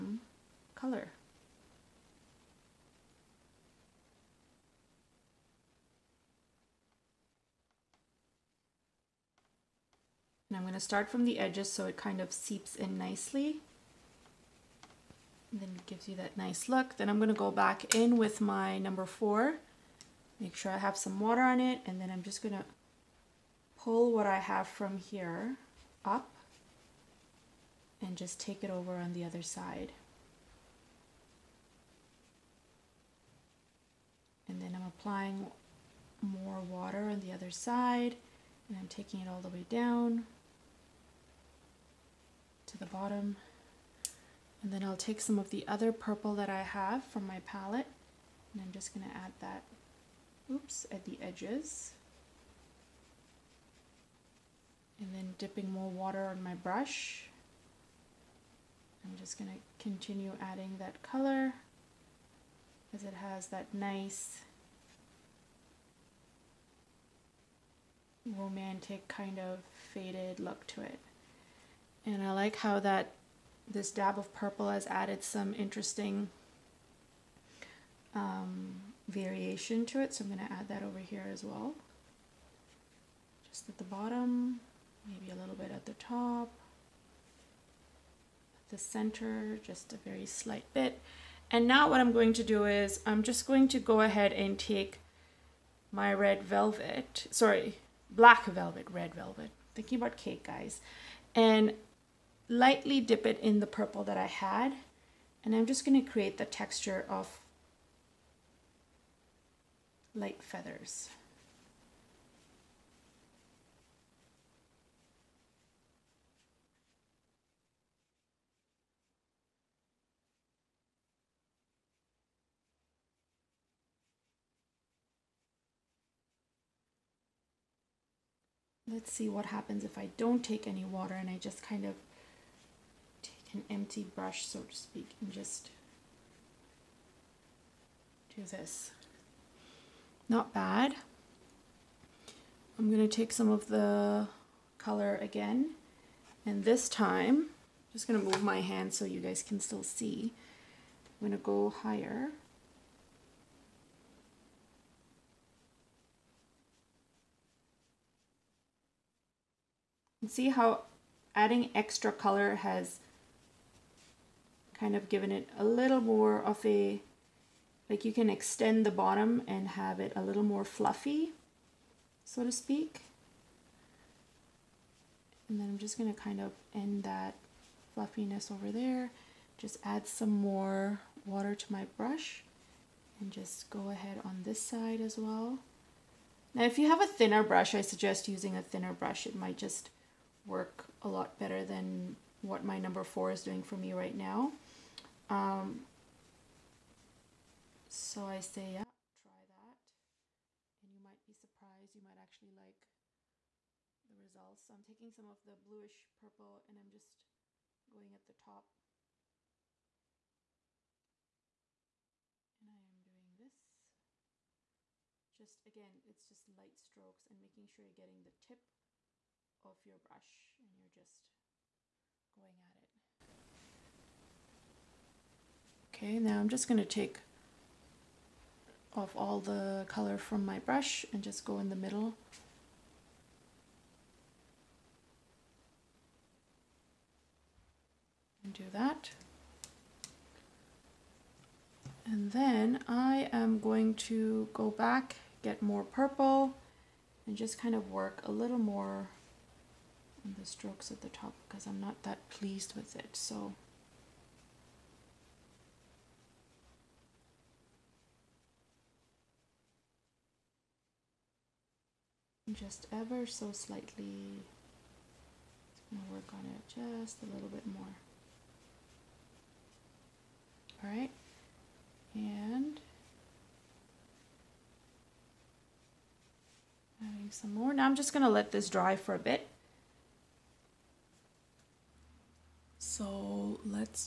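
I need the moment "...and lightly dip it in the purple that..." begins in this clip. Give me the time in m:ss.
1:41.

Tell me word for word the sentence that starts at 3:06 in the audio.
Now if you have a thinner brush, I suggest using a thinner brush.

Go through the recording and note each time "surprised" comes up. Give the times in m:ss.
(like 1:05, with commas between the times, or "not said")
3:21.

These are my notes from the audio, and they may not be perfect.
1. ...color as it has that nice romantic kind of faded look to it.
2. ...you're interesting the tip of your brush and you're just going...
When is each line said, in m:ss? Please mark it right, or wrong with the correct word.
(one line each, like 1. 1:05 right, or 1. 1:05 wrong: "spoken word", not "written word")
1. 1:01 right
2. 3:37 wrong: "getting", not "interesting".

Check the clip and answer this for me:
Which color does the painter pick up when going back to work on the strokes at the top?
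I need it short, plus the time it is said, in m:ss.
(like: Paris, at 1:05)
bluish purple, at 3:25.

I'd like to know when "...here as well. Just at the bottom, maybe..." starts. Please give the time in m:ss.
1:20.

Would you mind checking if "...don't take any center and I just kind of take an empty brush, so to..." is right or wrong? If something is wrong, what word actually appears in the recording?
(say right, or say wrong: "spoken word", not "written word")
wrong: "water", not "center".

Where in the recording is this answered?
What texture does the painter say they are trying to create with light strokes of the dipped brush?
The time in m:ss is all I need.
1:50.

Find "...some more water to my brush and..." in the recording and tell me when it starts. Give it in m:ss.
3:00.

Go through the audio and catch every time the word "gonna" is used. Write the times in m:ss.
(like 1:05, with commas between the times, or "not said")
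0:22, 0:48.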